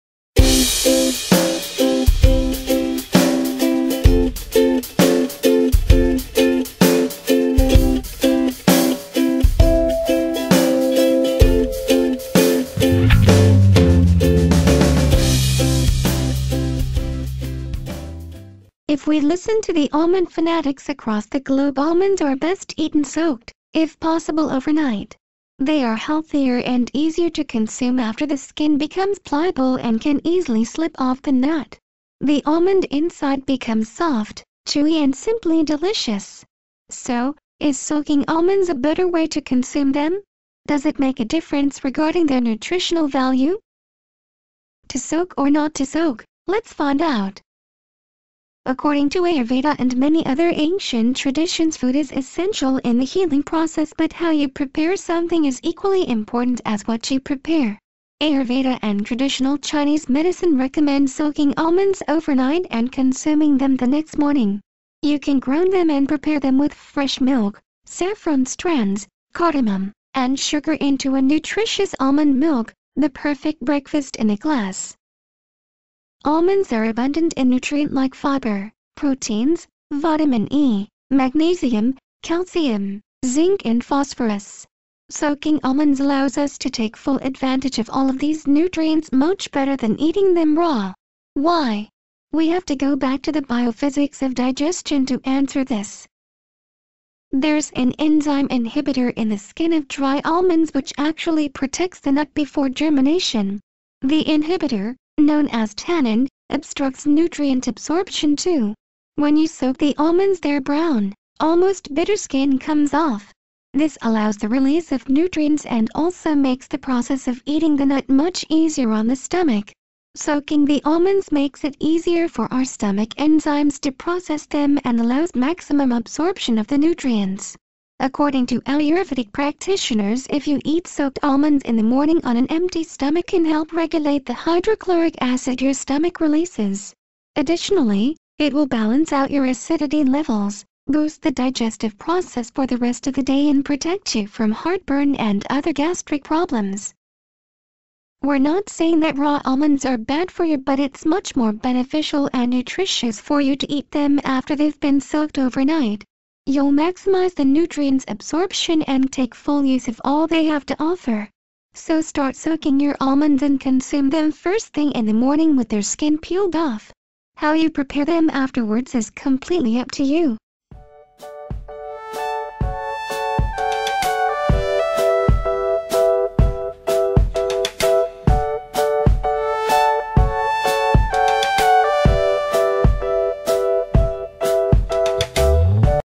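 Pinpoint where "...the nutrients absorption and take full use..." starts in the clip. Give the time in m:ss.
2:37.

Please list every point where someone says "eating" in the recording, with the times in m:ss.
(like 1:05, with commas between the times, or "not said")
1:29, 1:57.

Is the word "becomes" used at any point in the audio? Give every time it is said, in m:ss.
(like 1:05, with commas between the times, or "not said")
0:28, 0:33.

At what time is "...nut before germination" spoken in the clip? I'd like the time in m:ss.
1:42.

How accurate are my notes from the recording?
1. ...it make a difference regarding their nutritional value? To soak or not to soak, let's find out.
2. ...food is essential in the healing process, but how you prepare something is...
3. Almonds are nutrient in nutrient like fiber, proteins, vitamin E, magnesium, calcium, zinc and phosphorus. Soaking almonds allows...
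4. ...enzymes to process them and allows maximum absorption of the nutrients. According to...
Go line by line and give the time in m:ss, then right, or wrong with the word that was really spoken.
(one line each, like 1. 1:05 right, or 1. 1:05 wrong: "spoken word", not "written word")
1. 0:40 right
2. 0:51 right
3. 1:16 wrong: "abundant", not "nutrient"
4. 2:03 right.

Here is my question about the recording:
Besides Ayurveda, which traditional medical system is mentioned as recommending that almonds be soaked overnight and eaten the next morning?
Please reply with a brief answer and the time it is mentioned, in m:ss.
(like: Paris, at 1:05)
Traditional Chinese medicine, at 0:59.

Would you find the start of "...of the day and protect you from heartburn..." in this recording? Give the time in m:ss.
2:23.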